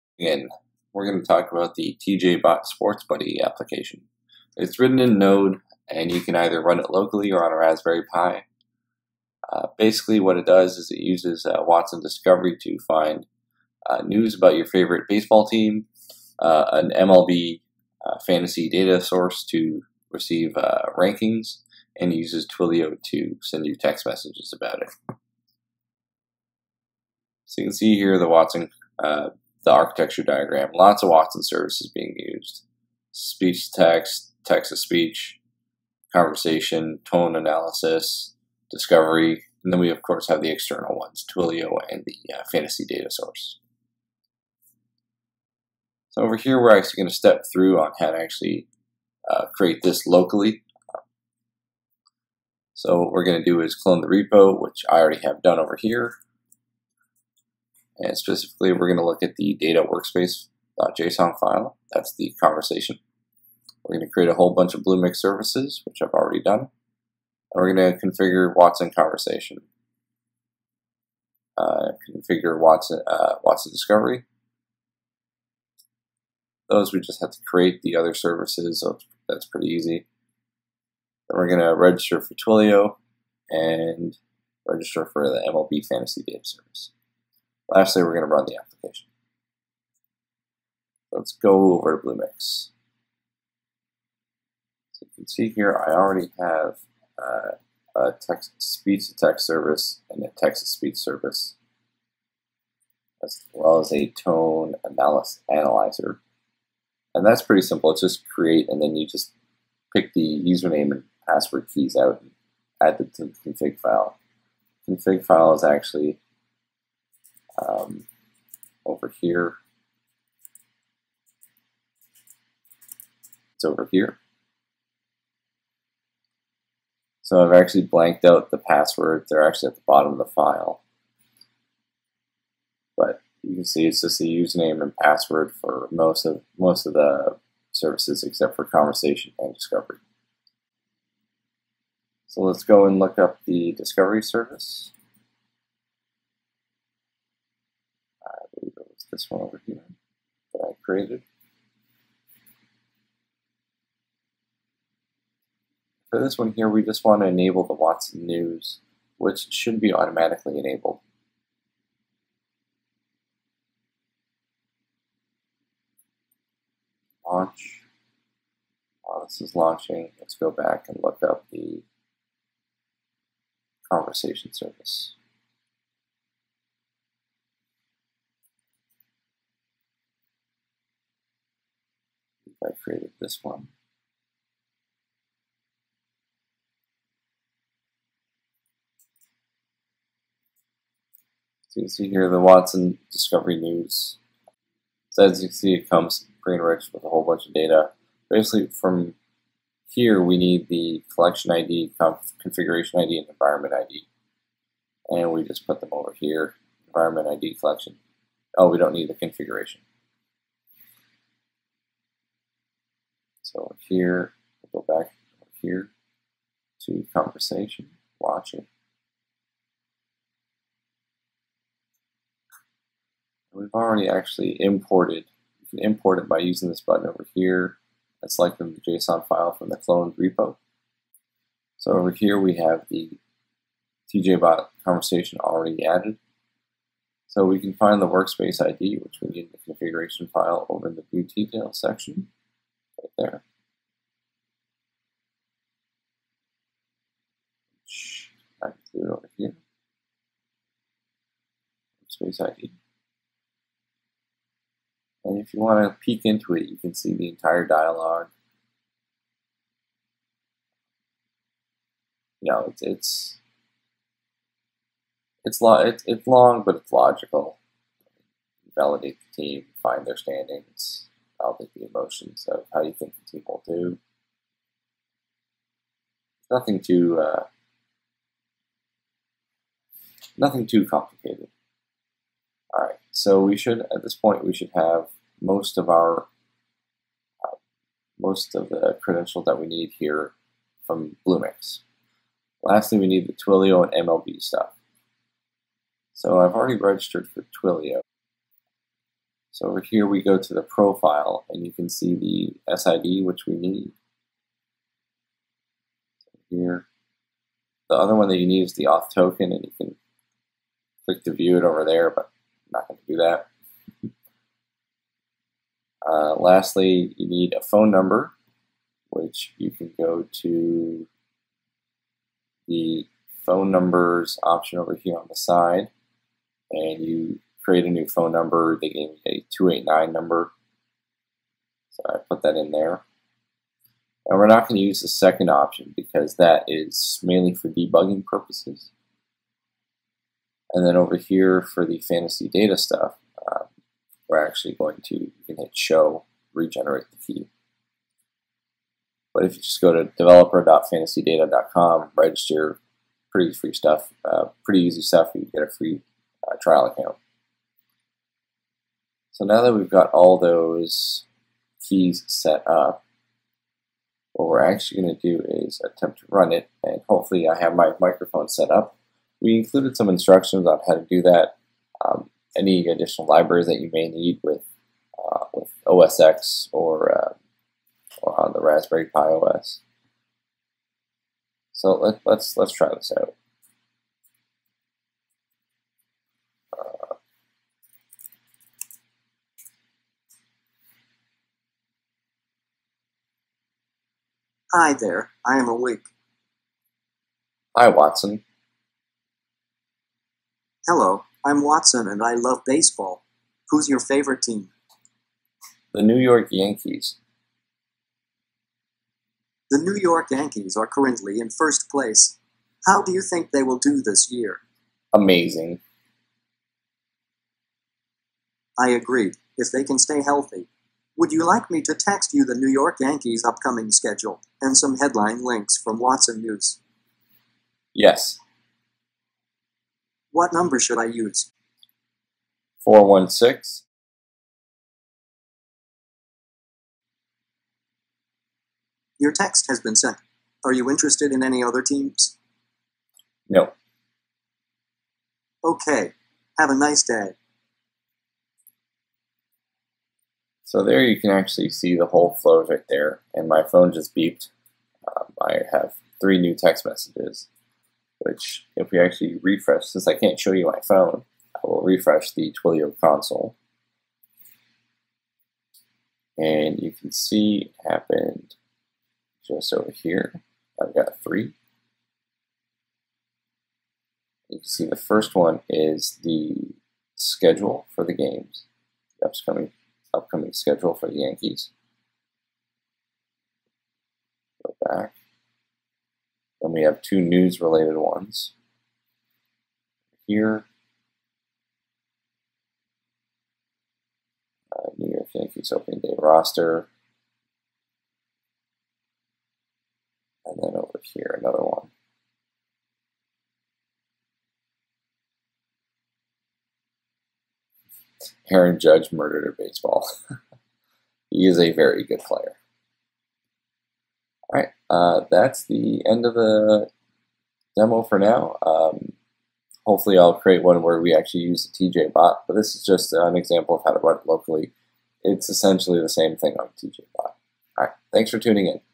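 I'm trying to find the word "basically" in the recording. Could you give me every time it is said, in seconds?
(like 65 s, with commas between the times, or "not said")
9 s, 198 s.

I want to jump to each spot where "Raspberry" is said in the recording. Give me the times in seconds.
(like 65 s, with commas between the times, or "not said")
7 s, 378 s.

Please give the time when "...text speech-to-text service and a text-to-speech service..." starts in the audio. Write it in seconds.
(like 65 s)
98 s.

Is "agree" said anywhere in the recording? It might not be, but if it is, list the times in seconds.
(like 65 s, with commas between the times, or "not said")
418 s.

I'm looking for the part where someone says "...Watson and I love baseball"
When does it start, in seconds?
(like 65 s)
401 s.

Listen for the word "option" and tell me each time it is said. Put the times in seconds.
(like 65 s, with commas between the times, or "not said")
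324 s, 335 s.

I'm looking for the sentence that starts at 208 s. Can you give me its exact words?
Oh, we don't need the configuration.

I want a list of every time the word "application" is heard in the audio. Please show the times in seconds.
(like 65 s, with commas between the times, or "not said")
3 s, 88 s.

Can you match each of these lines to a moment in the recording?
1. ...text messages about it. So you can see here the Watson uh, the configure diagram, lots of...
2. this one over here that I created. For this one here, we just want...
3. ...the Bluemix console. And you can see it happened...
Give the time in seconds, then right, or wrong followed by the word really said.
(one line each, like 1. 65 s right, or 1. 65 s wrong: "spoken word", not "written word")
1. 23 s wrong: "architecture", not "configure"
2. 149 s right
3. 462 s wrong: "Twilio", not "Bluemix".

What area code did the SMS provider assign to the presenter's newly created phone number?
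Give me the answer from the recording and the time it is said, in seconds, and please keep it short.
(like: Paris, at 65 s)
289, at 329 s.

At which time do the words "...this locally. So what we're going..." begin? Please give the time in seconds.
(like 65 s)
49 s.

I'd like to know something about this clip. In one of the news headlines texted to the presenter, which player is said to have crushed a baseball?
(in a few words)
Aaron Judge.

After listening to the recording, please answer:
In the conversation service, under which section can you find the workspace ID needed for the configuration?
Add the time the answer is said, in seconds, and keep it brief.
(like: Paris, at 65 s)
view details, at 241 s.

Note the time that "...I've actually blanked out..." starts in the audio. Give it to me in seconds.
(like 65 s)
127 s.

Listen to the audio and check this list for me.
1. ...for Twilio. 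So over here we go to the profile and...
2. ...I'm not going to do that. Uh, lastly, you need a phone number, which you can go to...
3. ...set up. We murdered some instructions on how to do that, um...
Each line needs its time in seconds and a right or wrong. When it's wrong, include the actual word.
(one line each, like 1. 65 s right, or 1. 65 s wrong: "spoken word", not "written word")
1. 297 s right
2. 312 s right
3. 368 s wrong: "included", not "murdered".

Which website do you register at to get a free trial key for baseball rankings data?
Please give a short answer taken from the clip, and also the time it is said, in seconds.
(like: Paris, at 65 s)
developer.fantasydata.com, at 350 s.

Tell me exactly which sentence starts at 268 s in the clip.
Validate the team, find their standings about is the emotions of how you think the team will do.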